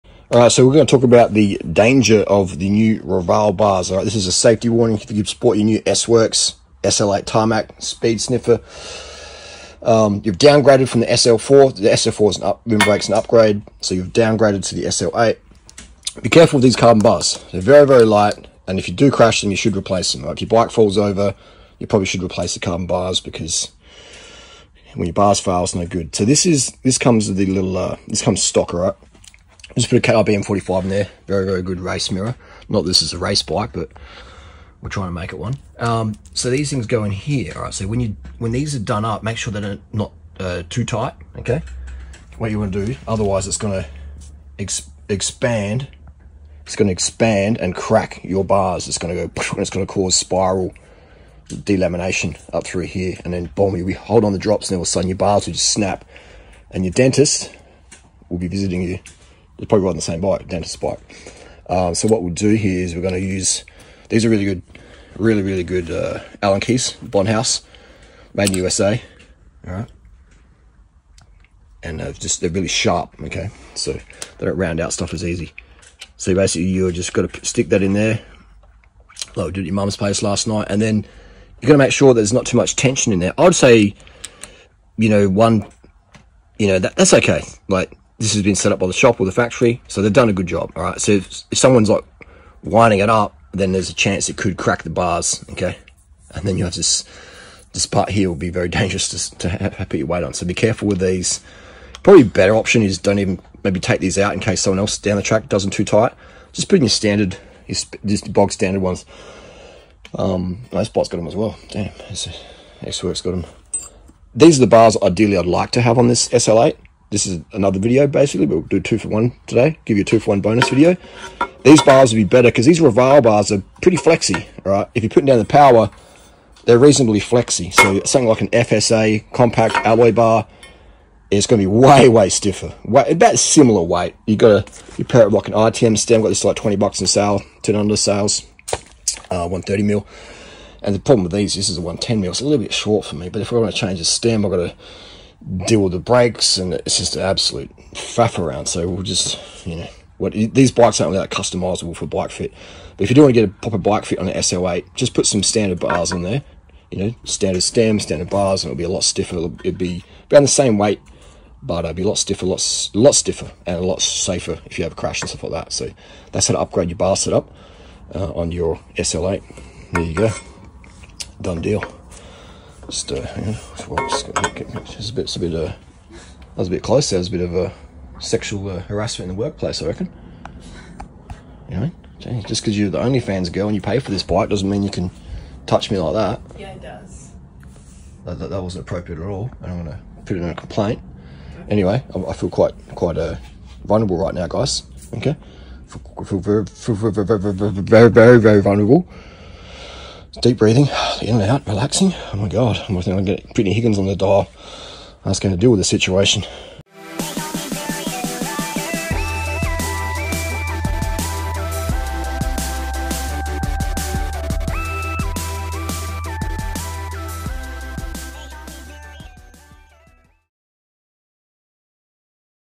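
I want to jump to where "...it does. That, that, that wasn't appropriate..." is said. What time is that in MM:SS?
03:06.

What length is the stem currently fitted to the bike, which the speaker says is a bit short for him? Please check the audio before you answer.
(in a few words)
110 mm.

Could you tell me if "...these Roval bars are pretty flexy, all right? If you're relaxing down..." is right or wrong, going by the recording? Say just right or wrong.
wrong.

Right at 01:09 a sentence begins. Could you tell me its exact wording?
All right, and they're uh, just they're really sharp.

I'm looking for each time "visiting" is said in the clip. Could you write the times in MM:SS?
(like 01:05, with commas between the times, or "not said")
00:58.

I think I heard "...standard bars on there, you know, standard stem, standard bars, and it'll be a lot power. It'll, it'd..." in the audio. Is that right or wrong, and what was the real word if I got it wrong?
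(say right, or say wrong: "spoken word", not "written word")
wrong: "stiffer", not "power".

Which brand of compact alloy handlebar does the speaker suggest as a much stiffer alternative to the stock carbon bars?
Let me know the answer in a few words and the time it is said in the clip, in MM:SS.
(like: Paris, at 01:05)
FSA, at 02:08.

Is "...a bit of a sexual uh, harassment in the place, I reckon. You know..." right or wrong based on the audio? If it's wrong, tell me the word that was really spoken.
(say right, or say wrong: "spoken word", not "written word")
wrong: "workplace", not "place".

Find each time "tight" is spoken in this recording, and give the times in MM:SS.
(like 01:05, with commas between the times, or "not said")
00:40, 01:45.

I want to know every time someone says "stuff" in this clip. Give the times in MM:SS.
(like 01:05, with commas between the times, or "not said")
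01:14, 02:45.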